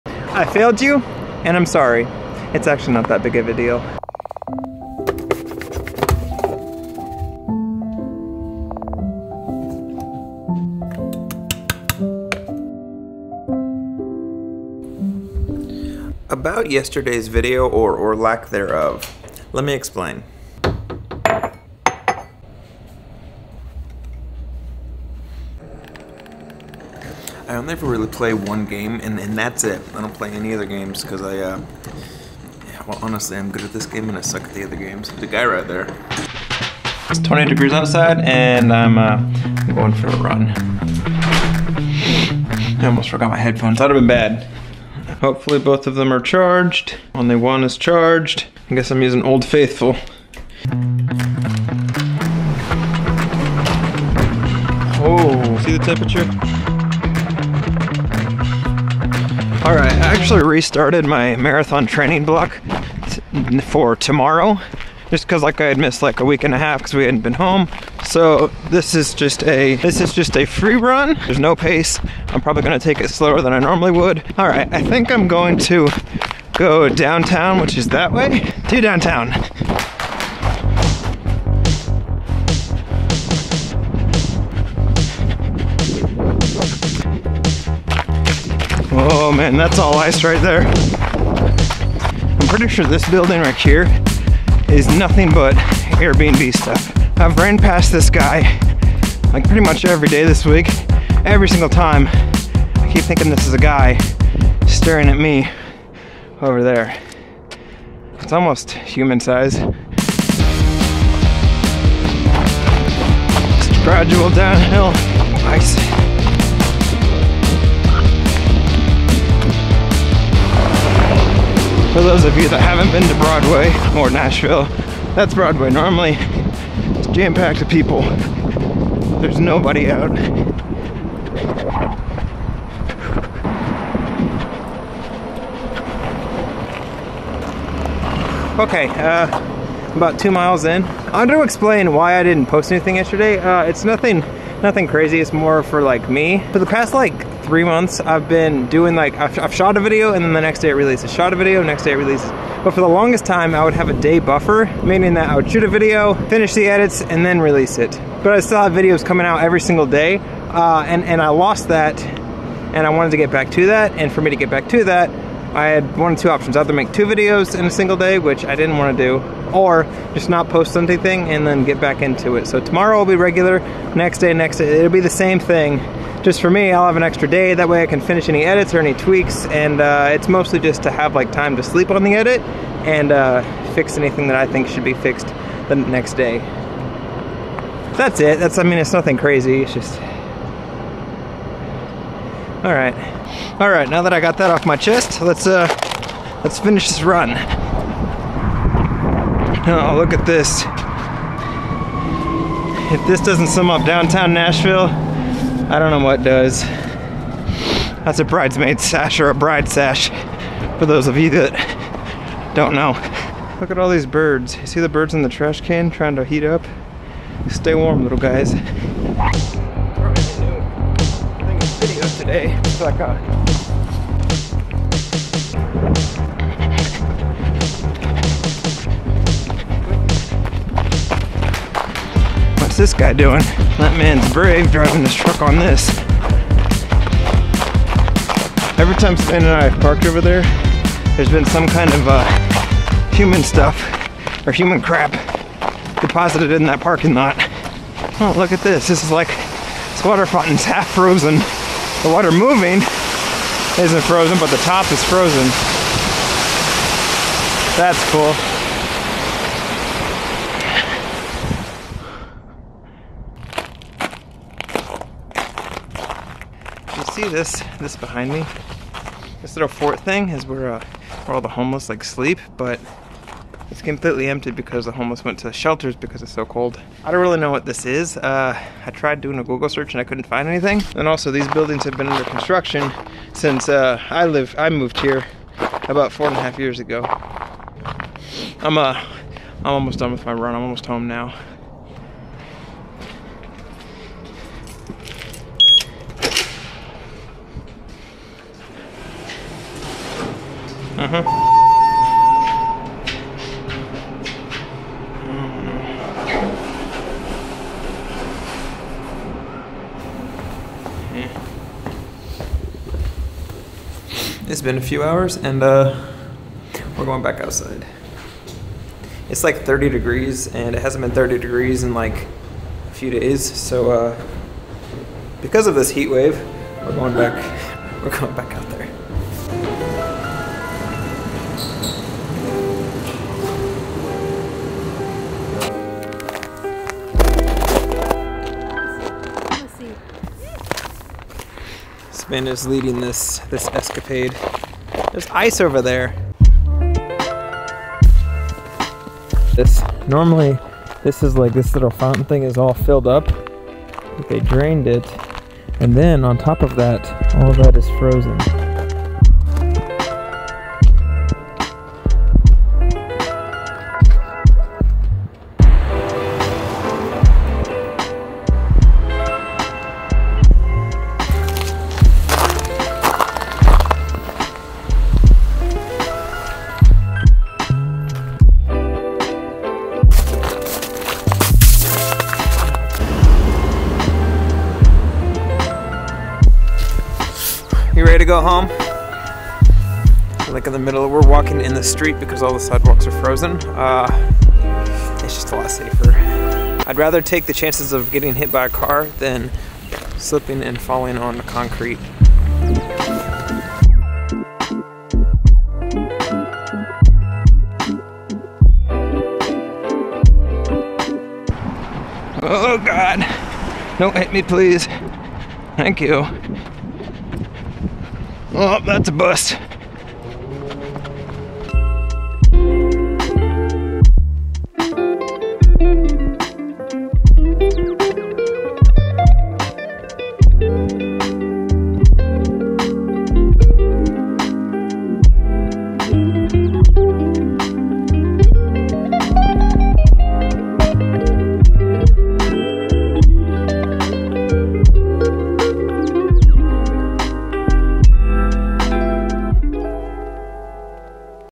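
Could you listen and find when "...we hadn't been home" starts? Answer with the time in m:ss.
1:06.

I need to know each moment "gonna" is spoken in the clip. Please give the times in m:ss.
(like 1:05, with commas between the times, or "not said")
1:12.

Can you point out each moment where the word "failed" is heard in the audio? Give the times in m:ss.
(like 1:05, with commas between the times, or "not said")
0:00.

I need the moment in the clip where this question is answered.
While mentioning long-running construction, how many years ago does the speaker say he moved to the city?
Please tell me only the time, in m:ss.
4:46.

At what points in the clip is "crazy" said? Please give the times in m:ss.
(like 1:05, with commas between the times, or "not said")
2:24, 3:09.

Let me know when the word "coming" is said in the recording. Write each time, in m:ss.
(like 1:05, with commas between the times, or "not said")
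2:39.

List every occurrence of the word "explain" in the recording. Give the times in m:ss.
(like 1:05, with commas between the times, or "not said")
0:19, 2:21.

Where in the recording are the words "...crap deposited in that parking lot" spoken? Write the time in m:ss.
4:04.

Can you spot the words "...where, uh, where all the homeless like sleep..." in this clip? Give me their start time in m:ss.
4:30.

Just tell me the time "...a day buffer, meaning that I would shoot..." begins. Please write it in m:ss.
2:33.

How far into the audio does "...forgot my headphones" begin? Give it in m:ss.
0:43.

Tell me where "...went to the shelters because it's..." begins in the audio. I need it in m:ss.
4:35.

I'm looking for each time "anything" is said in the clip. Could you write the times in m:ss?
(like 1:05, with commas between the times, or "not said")
2:22, 2:50, 3:03, 4:40.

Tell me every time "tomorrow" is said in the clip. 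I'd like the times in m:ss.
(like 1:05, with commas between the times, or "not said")
1:03, 2:52.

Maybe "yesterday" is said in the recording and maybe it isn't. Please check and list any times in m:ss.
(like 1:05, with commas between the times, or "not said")
0:16, 2:22.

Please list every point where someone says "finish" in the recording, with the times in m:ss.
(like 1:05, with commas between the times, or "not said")
2:36, 2:58, 3:16.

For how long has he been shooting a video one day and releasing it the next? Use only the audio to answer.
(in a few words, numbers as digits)
3 months.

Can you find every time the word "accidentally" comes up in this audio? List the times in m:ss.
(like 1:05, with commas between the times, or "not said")
not said.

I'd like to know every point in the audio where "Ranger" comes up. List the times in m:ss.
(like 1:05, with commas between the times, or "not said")
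not said.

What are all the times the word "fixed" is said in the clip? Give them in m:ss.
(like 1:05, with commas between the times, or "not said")
3:04.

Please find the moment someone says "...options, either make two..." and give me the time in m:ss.
2:46.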